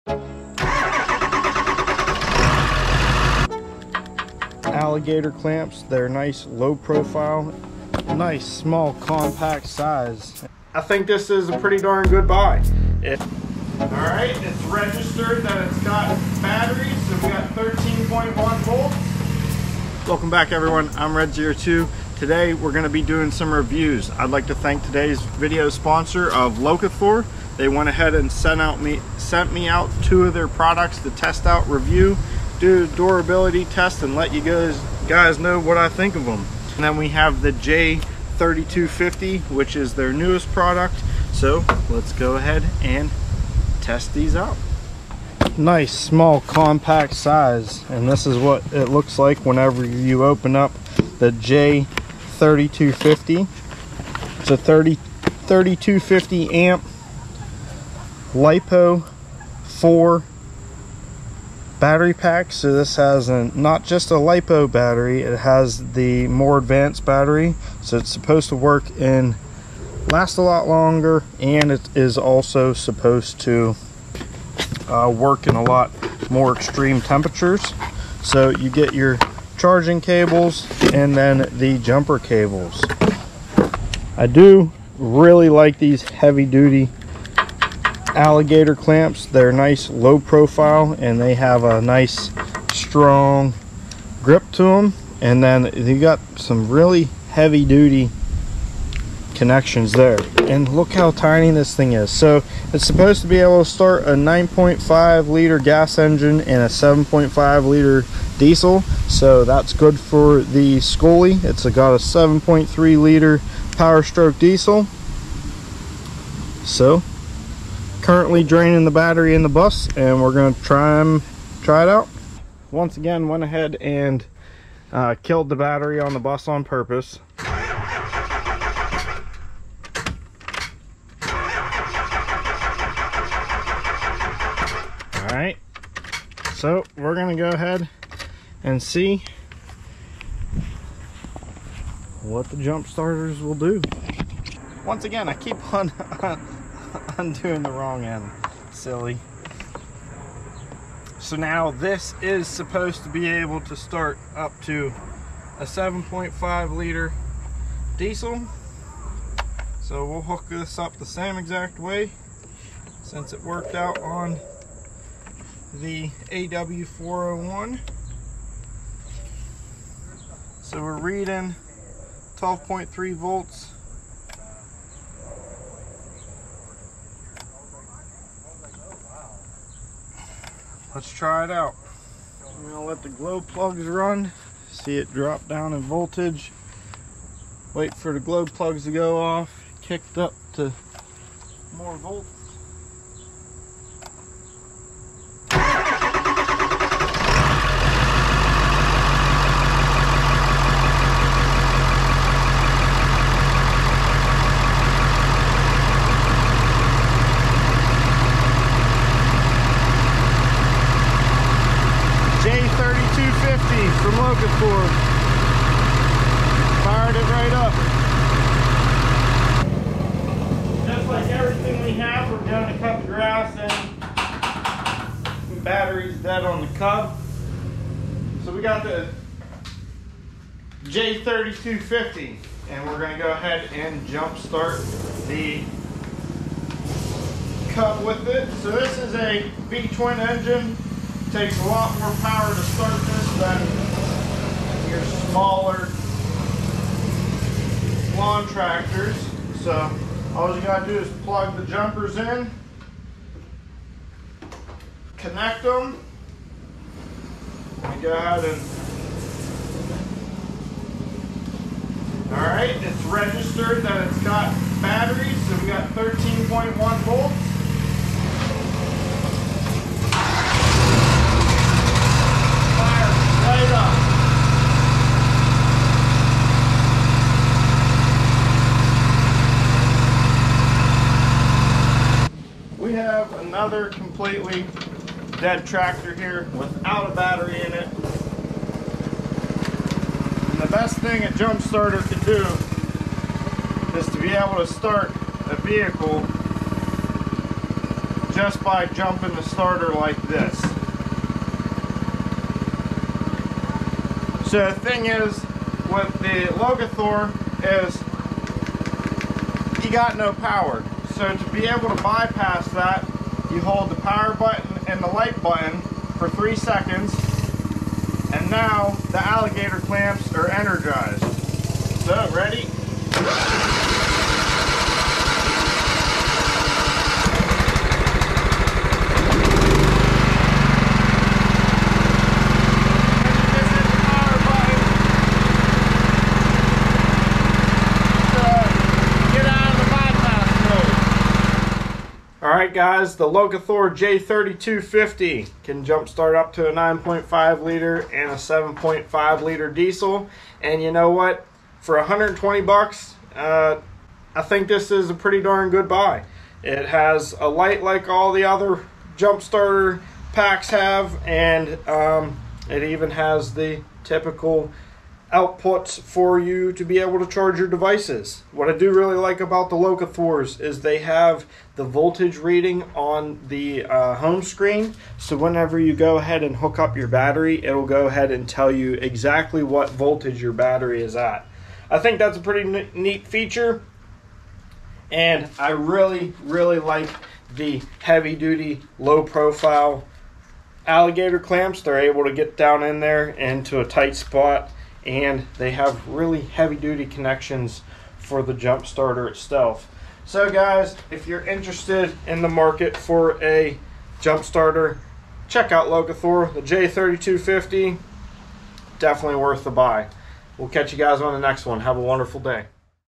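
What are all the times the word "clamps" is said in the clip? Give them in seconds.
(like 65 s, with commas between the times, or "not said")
5 s, 88 s, 319 s, 391 s.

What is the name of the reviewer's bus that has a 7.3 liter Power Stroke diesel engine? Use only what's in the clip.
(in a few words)
Scully.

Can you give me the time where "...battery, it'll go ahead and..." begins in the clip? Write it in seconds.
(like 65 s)
377 s.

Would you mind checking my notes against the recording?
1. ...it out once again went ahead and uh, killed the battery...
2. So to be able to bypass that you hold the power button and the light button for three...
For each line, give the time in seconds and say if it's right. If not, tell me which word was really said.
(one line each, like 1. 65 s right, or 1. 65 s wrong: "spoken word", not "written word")
1. 121 s right
2. 311 s right.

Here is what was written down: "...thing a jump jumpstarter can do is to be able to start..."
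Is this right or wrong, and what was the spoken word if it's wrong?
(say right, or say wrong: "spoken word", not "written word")
wrong: "starter", not "jumpstarter".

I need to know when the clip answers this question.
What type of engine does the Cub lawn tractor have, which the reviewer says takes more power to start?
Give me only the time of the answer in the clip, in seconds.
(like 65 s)
239 s.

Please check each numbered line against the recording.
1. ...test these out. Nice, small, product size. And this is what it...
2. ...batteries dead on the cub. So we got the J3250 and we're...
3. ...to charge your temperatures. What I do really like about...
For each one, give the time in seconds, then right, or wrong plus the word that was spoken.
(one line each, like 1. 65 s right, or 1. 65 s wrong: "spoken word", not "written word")
1. 43 s wrong: "compact", not "product"
2. 225 s right
3. 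367 s wrong: "devices", not "temperatures".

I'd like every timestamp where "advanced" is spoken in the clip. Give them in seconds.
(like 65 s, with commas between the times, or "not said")
66 s.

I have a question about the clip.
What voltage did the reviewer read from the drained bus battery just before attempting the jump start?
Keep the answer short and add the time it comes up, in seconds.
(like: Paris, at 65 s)
12.3 volts, at 172 s.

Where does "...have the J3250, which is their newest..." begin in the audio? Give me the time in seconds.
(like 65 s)
37 s.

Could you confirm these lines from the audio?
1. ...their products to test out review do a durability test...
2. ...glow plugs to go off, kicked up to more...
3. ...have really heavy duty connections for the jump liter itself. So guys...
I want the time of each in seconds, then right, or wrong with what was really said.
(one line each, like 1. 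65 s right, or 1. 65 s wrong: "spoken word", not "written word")
1. 30 s right
2. 188 s right
3. 395 s wrong: "starter", not "liter".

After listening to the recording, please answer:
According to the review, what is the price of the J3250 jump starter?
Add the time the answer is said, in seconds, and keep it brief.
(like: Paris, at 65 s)
$120, at 351 s.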